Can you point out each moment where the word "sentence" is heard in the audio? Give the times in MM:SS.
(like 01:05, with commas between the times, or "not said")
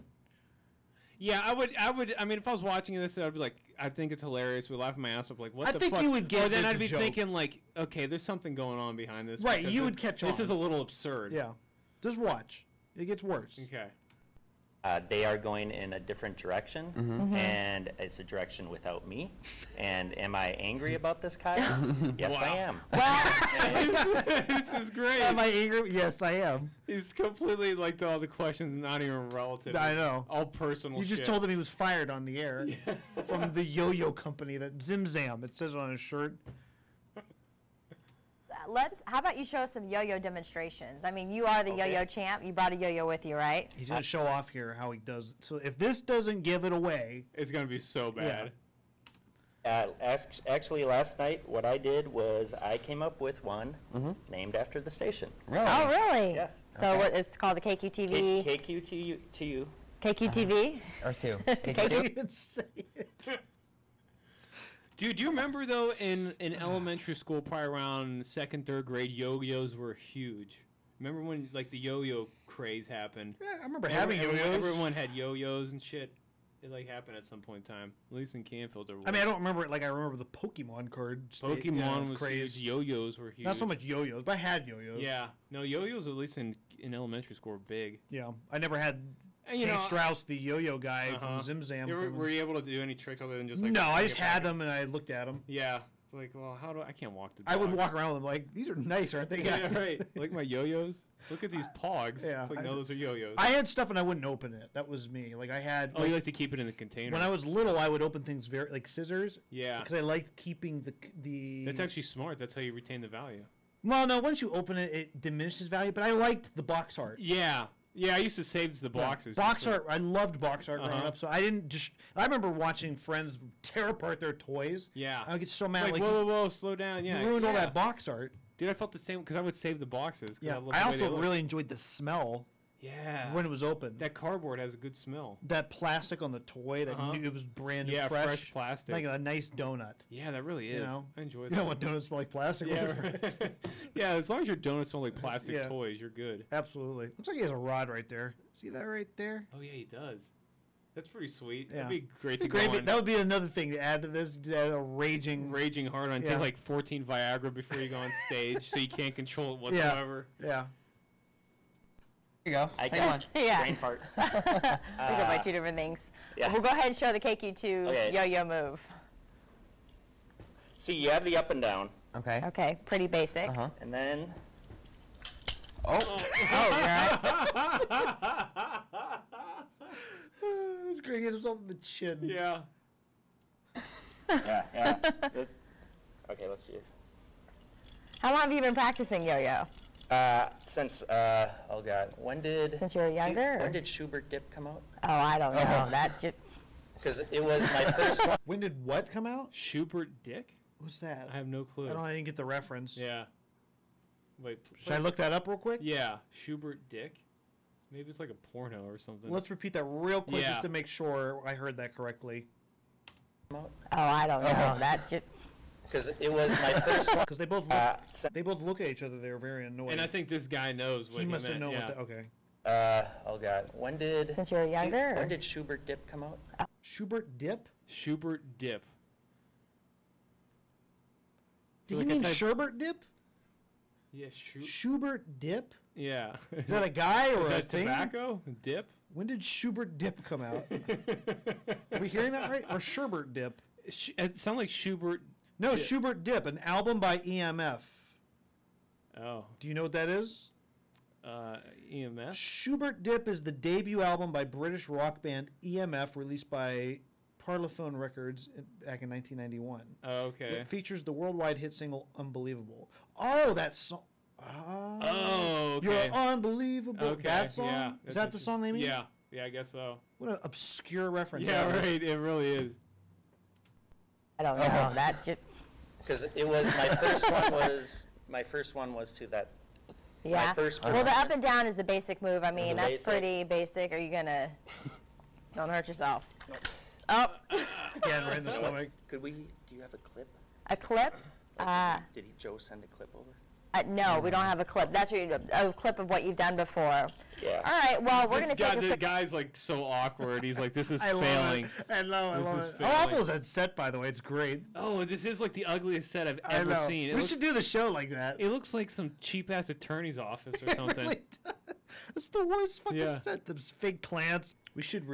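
not said.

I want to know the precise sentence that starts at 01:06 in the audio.
elementary school, probably around second, third grade, yo-yos were huge.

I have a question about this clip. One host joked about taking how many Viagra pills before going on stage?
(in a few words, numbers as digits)
14.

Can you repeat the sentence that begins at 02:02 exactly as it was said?
I remember watching friends tear apart their toys.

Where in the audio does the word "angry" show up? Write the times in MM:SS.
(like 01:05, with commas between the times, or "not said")
00:20, 00:25.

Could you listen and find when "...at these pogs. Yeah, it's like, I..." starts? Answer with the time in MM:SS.
01:41.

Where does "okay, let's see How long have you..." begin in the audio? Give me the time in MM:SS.
03:06.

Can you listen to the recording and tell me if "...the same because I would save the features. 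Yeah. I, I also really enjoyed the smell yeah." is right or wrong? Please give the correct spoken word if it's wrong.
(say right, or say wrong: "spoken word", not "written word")
wrong: "boxes", not "features".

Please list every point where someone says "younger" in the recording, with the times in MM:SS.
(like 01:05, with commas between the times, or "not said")
03:13, 03:44.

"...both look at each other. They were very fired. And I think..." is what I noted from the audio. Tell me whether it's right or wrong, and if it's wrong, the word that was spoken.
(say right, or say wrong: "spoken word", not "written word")
wrong: "annoyed", not "fired".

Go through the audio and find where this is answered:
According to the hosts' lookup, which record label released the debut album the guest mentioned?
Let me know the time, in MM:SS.
04:16.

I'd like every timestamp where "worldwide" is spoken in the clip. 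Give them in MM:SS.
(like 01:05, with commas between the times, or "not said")
04:21.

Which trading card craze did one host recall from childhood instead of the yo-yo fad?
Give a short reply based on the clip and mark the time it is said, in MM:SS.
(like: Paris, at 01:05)
Pokemon cards, at 01:19.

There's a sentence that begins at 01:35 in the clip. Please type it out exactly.
Yeah, like, well, how do I, I can't walk the dog.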